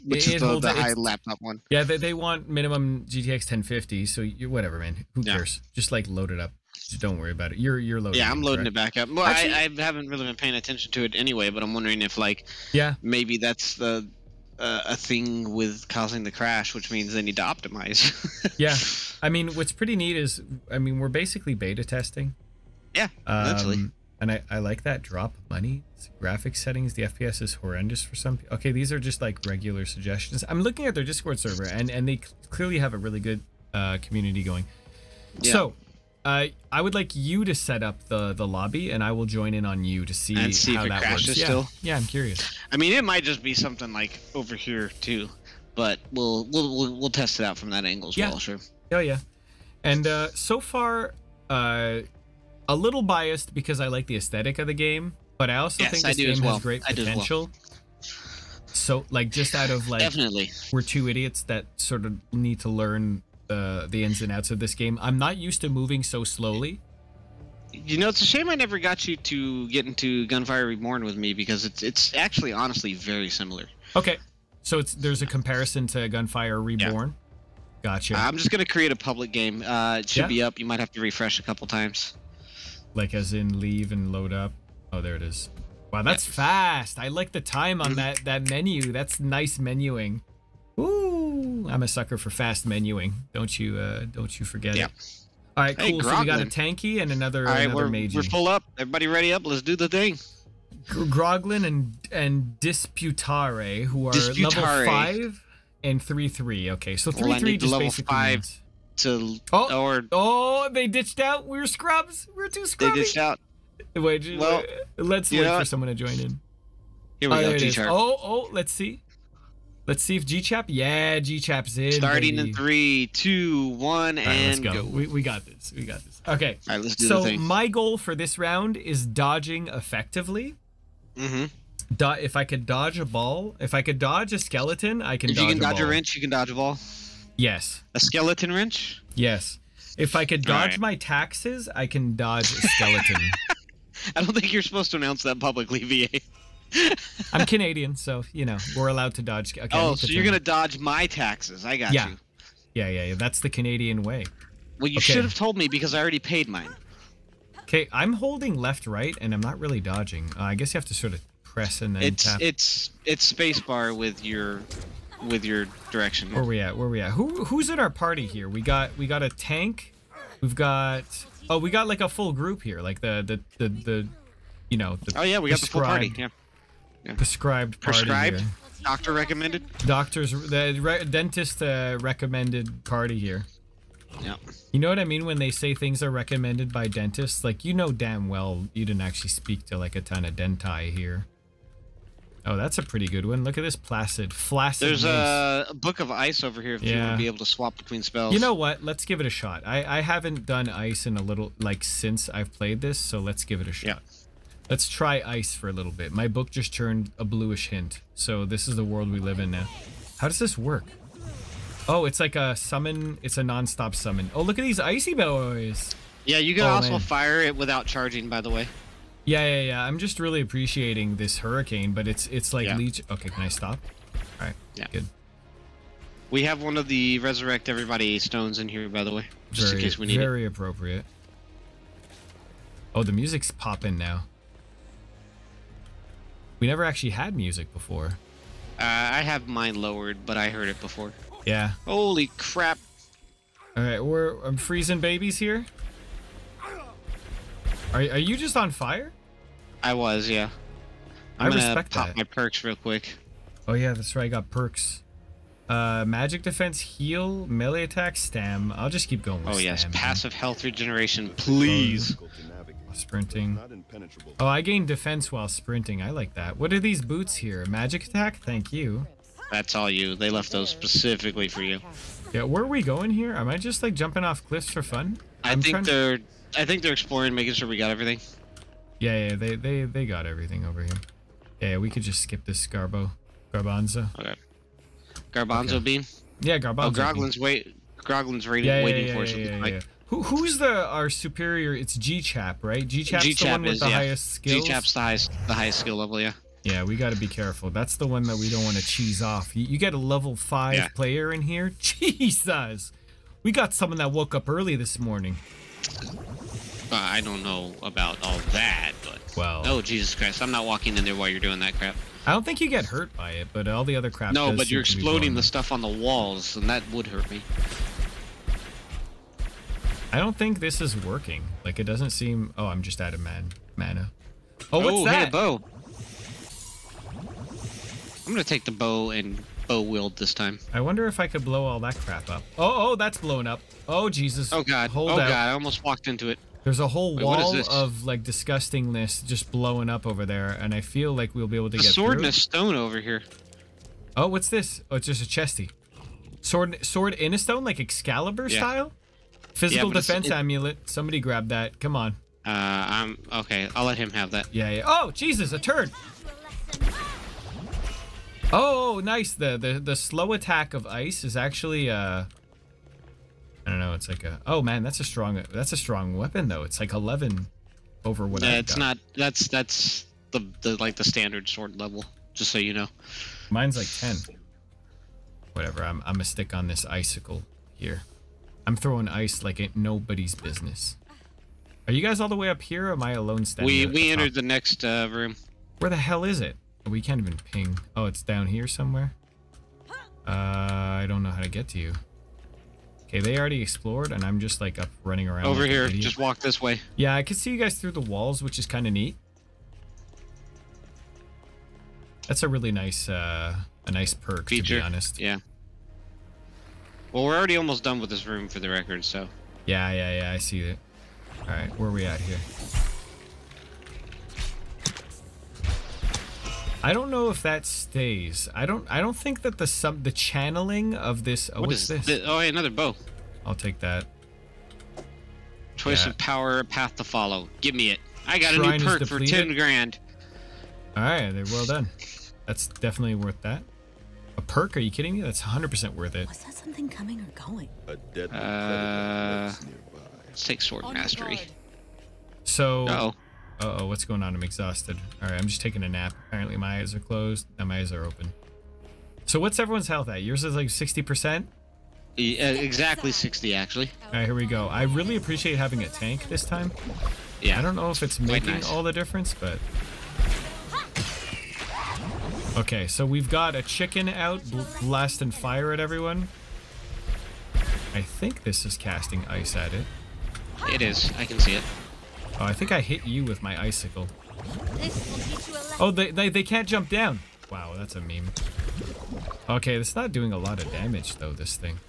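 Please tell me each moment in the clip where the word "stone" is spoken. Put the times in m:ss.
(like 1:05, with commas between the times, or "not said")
3:48, 5:42, 5:47.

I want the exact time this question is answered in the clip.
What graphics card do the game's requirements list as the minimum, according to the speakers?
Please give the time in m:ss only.
0:03.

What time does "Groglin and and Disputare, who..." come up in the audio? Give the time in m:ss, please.
1:40.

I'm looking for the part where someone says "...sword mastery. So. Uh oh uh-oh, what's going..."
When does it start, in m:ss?
7:20.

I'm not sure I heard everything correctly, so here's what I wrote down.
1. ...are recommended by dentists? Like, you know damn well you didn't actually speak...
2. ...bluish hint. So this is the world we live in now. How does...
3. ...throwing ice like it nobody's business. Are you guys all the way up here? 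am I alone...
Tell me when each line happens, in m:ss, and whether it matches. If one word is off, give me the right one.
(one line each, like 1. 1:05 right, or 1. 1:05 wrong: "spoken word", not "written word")
1. 3:06 right
2. 3:27 right
3. 6:18 right.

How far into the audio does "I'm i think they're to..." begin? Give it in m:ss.
4:35.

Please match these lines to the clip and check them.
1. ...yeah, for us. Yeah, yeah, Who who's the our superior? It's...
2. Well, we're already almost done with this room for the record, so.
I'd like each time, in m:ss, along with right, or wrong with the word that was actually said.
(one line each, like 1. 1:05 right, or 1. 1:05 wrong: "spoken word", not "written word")
1. 4:49 right
2. 6:47 right.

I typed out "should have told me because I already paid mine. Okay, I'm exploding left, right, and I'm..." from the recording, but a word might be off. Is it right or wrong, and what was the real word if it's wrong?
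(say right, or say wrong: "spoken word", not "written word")
wrong: "holding", not "exploding".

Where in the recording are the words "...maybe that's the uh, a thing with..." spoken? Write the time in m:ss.
0:13.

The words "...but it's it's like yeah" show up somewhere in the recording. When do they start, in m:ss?
3:41.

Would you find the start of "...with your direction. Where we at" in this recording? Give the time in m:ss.
2:45.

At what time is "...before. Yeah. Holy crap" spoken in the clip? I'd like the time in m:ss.
4:00.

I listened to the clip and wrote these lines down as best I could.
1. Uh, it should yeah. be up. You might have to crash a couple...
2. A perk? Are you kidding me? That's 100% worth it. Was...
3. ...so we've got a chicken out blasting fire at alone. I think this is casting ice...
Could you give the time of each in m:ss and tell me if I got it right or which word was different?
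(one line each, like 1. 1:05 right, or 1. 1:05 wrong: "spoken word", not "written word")
1. 1:19 wrong: "refresh", not "crash"
2. 7:14 right
3. 7:42 wrong: "everyone", not "alone".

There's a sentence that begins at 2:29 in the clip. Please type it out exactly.
Okay, oh, so you're gonna dodge my taxes?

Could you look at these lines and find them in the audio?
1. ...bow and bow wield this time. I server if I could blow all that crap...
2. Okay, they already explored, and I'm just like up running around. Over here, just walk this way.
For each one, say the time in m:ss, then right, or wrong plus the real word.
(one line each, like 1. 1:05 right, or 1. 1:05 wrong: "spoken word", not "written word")
1. 5:28 wrong: "wonder", not "server"
2. 6:33 right.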